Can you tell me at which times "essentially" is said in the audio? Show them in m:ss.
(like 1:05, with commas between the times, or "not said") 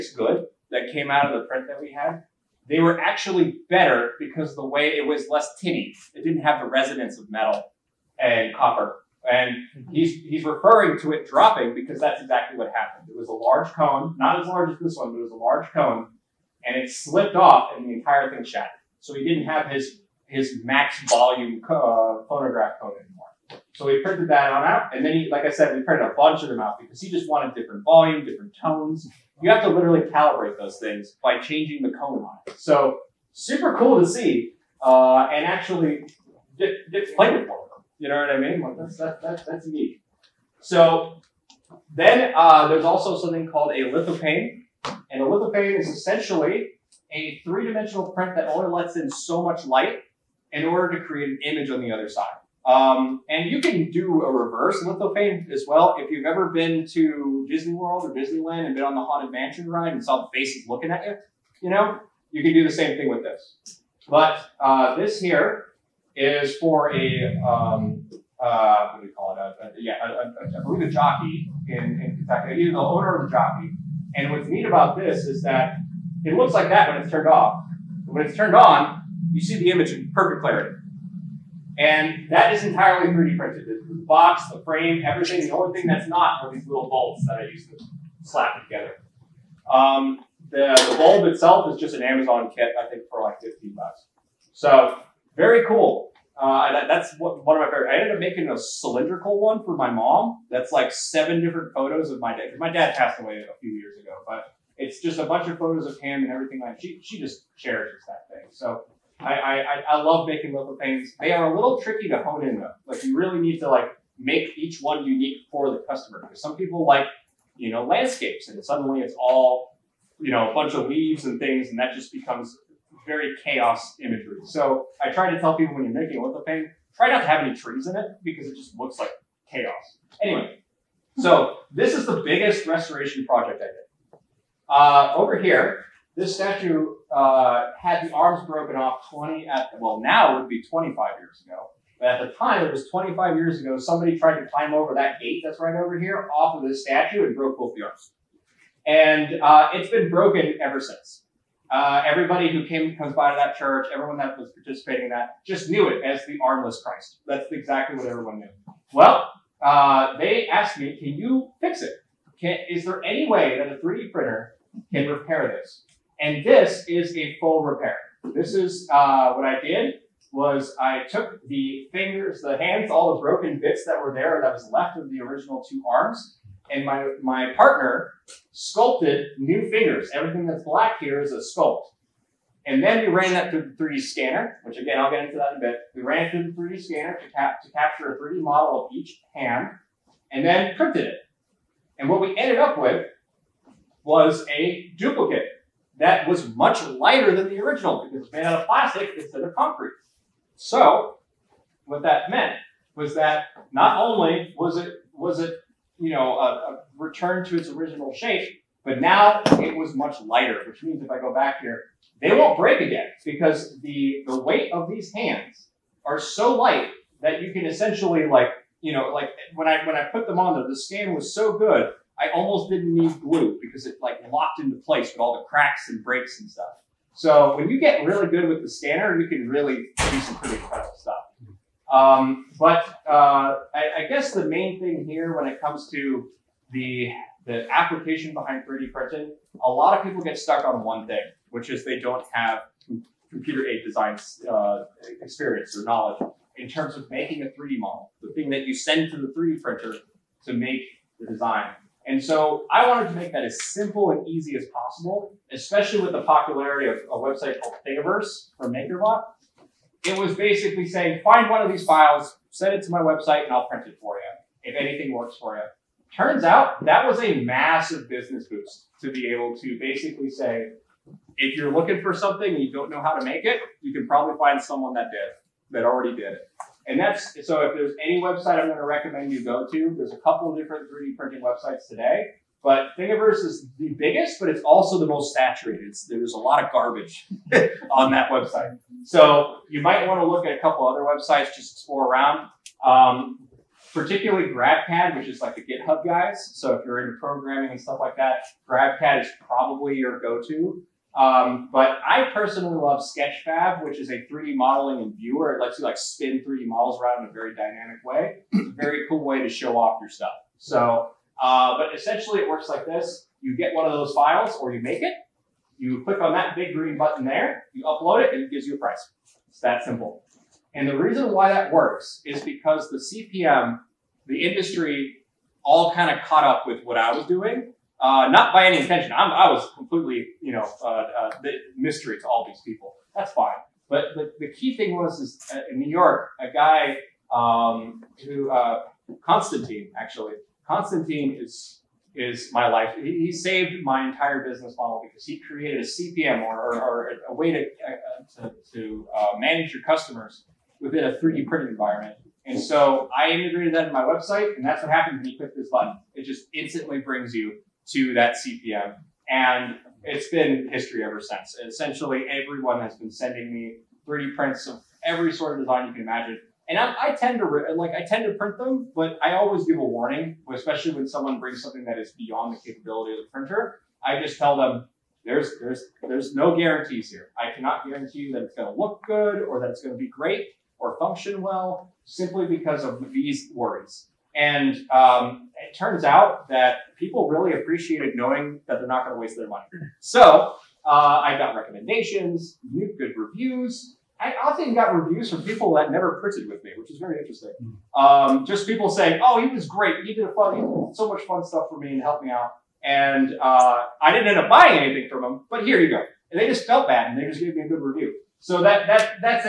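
0:45, 3:37, 5:11, 6:01.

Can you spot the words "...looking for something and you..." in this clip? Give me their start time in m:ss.
4:31.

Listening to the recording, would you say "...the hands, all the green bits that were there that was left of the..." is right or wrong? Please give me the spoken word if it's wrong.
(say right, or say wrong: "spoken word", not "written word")
wrong: "broken", not "green".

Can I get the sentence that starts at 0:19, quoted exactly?
So he didn't have his, his max volume co- uh, phonograph cone anymore.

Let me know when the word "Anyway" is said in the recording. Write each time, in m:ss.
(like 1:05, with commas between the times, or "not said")
2:10.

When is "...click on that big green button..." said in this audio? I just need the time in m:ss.
5:16.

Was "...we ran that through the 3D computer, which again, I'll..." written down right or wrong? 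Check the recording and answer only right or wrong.
wrong.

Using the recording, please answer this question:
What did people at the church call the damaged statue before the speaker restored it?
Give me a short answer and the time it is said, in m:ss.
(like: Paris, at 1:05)
The armless Christ, at 2:36.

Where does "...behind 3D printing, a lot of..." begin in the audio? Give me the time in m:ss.
3:58.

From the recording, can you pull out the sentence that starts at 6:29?
So uh, I got recommendations, good reviews, I often got reviews from people that never printed with me, which is very interesting.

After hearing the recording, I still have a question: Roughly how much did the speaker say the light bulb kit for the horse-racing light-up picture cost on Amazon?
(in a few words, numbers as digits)
$15.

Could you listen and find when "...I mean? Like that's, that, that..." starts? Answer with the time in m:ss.
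0:38.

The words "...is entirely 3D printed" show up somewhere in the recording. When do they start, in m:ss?
1:22.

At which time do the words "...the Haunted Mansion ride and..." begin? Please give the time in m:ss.
0:58.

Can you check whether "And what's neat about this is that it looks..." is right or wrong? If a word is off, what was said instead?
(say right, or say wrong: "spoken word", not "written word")
right.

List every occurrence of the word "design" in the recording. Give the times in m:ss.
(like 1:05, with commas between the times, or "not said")
4:03, 4:11, 6:05.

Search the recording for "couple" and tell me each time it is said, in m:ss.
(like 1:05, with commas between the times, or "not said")
4:40, 4:50.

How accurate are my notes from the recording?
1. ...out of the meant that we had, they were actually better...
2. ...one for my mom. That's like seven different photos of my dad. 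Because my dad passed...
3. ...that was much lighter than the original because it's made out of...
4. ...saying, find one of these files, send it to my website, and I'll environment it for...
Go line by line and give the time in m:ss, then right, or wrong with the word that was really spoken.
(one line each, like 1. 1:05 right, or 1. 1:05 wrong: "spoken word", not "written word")
1. 0:01 wrong: "print", not "meant"
2. 1:39 right
3. 3:15 right
4. 4:20 wrong: "print", not "environment".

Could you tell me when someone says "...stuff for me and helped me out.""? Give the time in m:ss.
6:41.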